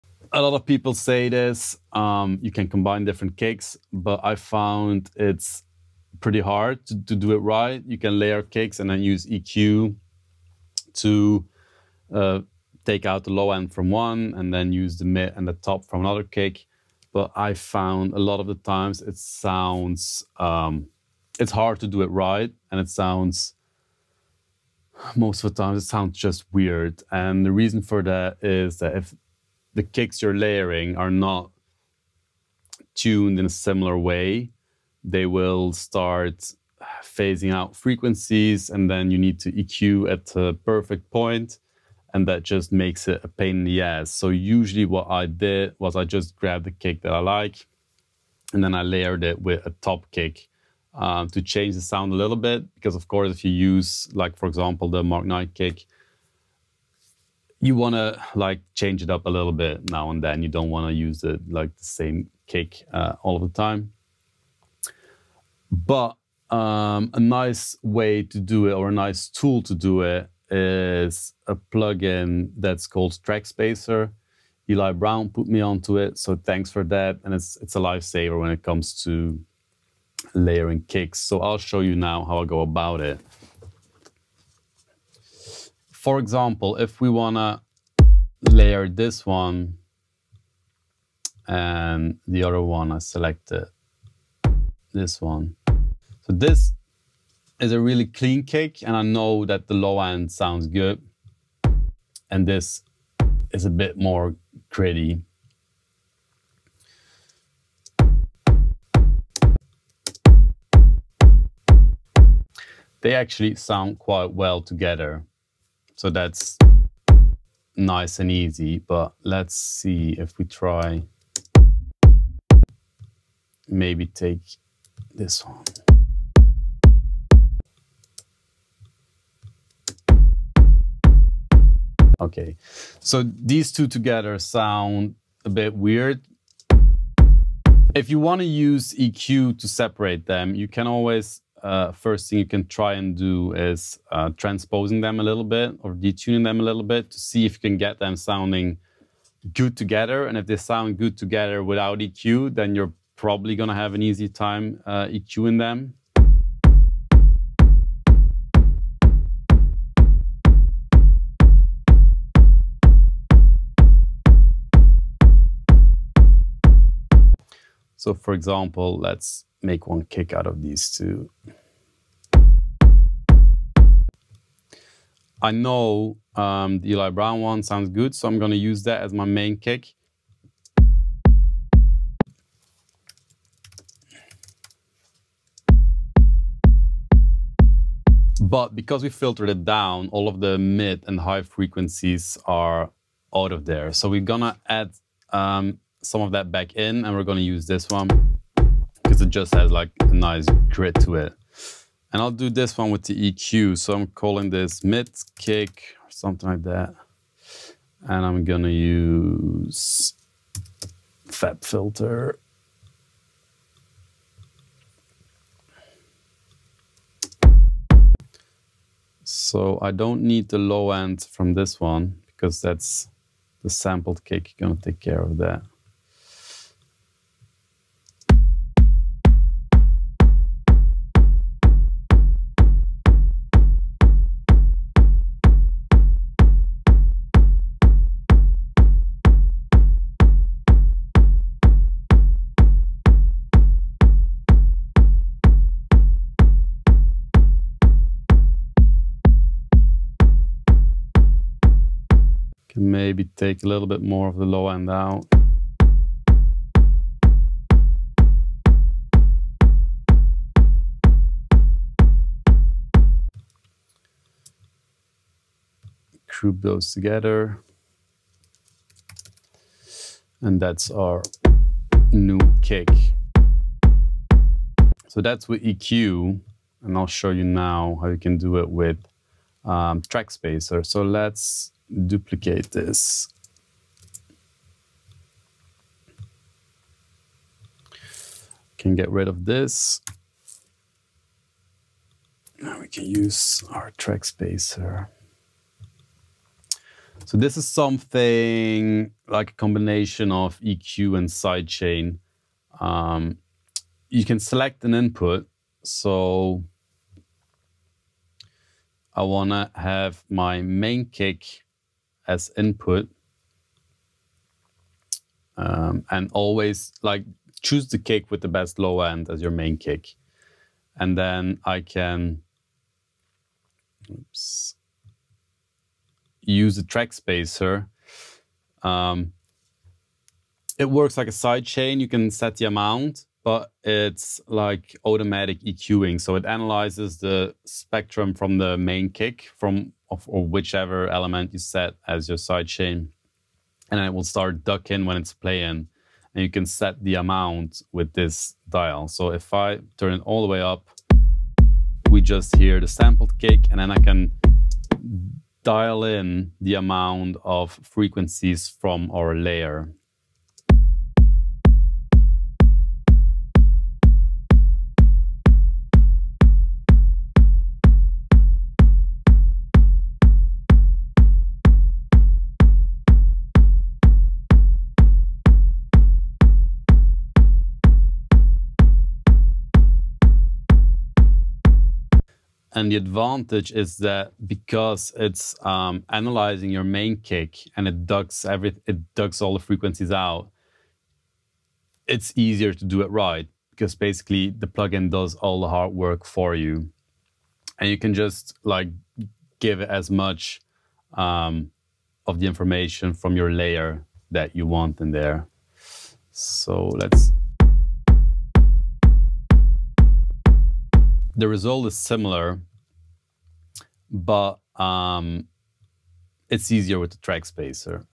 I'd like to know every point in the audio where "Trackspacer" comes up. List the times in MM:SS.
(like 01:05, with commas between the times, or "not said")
01:13, 04:40, 04:53, 05:26, 06:57.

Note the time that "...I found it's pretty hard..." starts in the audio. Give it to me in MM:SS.
00:04.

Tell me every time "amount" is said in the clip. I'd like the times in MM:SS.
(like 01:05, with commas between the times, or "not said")
05:32, 05:47, 05:56.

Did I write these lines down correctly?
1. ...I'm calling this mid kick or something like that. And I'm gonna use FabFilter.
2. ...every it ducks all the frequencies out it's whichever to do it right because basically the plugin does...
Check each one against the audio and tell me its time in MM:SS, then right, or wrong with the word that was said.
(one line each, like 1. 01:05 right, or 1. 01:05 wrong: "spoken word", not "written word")
1. 03:23 right
2. 06:28 wrong: "easier", not "whichever".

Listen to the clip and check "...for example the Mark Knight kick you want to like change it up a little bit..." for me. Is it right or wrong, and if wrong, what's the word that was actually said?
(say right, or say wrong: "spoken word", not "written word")
right.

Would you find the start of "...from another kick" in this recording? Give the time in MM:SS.
00:15.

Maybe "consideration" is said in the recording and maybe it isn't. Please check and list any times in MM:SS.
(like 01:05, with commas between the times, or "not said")
not said.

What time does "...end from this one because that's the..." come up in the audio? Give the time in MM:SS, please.
03:40.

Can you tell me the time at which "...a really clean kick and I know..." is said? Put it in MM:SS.
01:37.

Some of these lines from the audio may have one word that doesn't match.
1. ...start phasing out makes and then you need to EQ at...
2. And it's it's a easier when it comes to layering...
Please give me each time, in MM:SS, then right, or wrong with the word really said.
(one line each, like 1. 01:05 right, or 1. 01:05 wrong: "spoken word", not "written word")
1. 00:35 wrong: "frequencies", not "makes"
2. 01:17 wrong: "lifesaver", not "easier".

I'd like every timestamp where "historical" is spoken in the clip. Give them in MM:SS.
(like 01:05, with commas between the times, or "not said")
not said.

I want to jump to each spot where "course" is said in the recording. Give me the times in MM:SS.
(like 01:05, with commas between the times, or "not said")
00:53.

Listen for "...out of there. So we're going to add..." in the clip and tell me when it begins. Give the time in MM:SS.
03:13.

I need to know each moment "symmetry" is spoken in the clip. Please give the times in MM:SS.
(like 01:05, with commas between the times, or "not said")
not said.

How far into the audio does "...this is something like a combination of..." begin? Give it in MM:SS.
04:57.